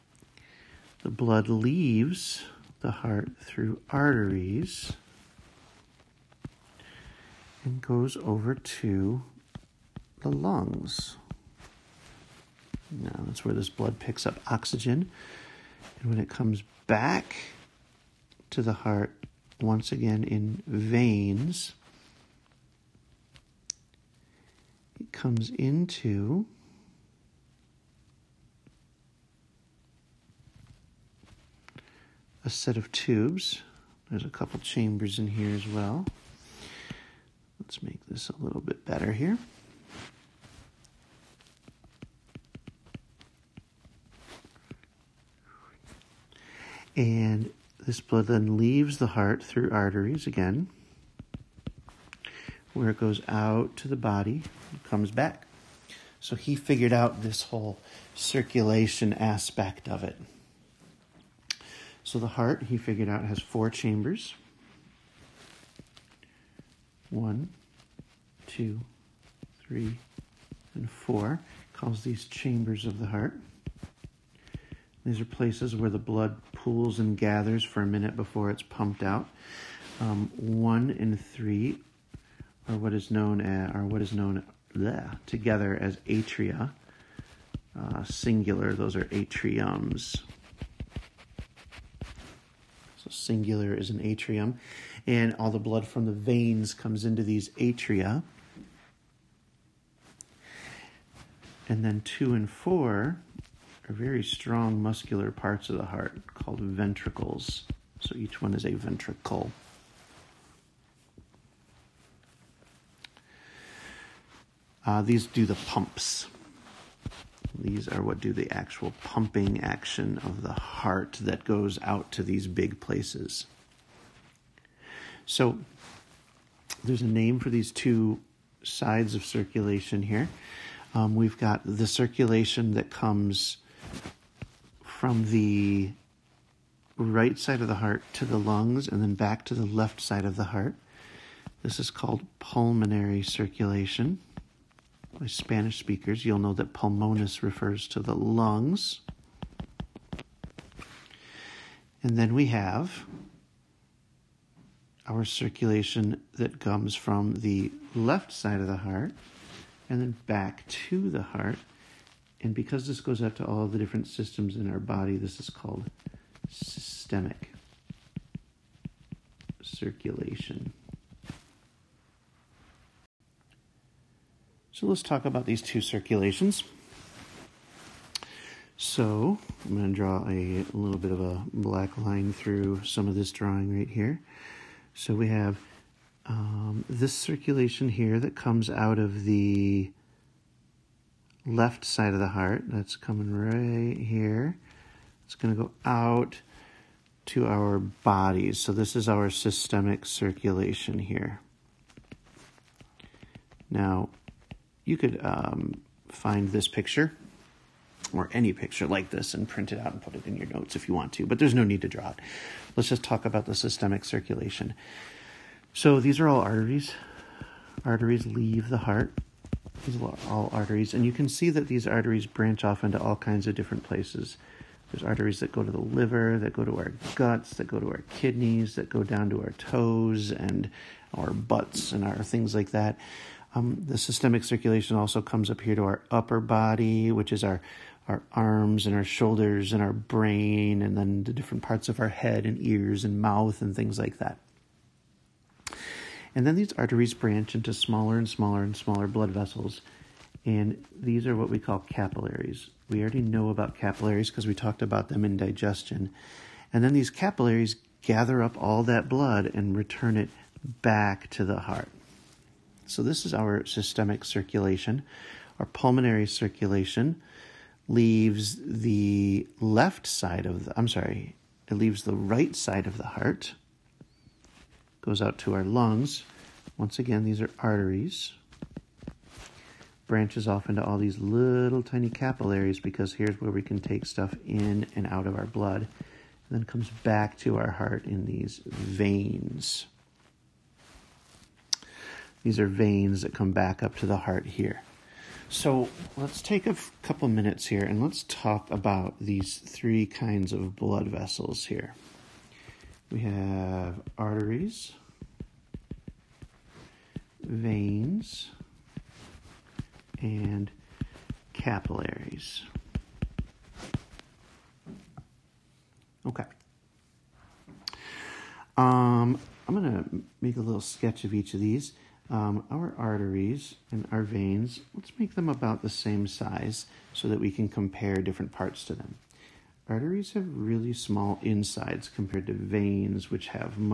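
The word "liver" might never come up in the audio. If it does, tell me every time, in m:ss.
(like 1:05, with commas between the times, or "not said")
3:45.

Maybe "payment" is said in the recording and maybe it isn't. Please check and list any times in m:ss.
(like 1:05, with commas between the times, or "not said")
not said.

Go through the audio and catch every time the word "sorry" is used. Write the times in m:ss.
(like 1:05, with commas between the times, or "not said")
4:30.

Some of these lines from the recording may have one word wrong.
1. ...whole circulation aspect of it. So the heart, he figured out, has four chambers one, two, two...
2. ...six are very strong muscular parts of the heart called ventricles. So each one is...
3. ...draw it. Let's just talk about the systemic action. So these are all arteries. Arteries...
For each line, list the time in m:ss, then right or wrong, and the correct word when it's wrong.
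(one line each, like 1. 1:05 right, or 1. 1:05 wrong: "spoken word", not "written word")
1. 0:57 wrong: "three", not "two"
2. 1:42 wrong: "four", not "six"
3. 3:31 wrong: "circulation", not "action".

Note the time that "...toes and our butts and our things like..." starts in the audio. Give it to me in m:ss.
3:49.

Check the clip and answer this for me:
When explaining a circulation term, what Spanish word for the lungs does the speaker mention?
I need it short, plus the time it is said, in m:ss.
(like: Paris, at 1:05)
pulmones, at 2:26.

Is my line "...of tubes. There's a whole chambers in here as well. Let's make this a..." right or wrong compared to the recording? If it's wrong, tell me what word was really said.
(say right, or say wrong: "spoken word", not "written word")
wrong: "couple", not "whole".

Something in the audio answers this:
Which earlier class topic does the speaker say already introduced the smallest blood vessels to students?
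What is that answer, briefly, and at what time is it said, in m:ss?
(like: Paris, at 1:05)
digestion, at 4:15.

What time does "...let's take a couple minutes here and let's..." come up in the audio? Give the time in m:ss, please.
4:56.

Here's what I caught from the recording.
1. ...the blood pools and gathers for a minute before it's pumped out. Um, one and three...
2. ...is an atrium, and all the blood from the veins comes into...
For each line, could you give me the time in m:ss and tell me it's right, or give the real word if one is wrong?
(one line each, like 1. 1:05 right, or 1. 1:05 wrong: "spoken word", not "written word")
1. 1:15 right
2. 1:33 right.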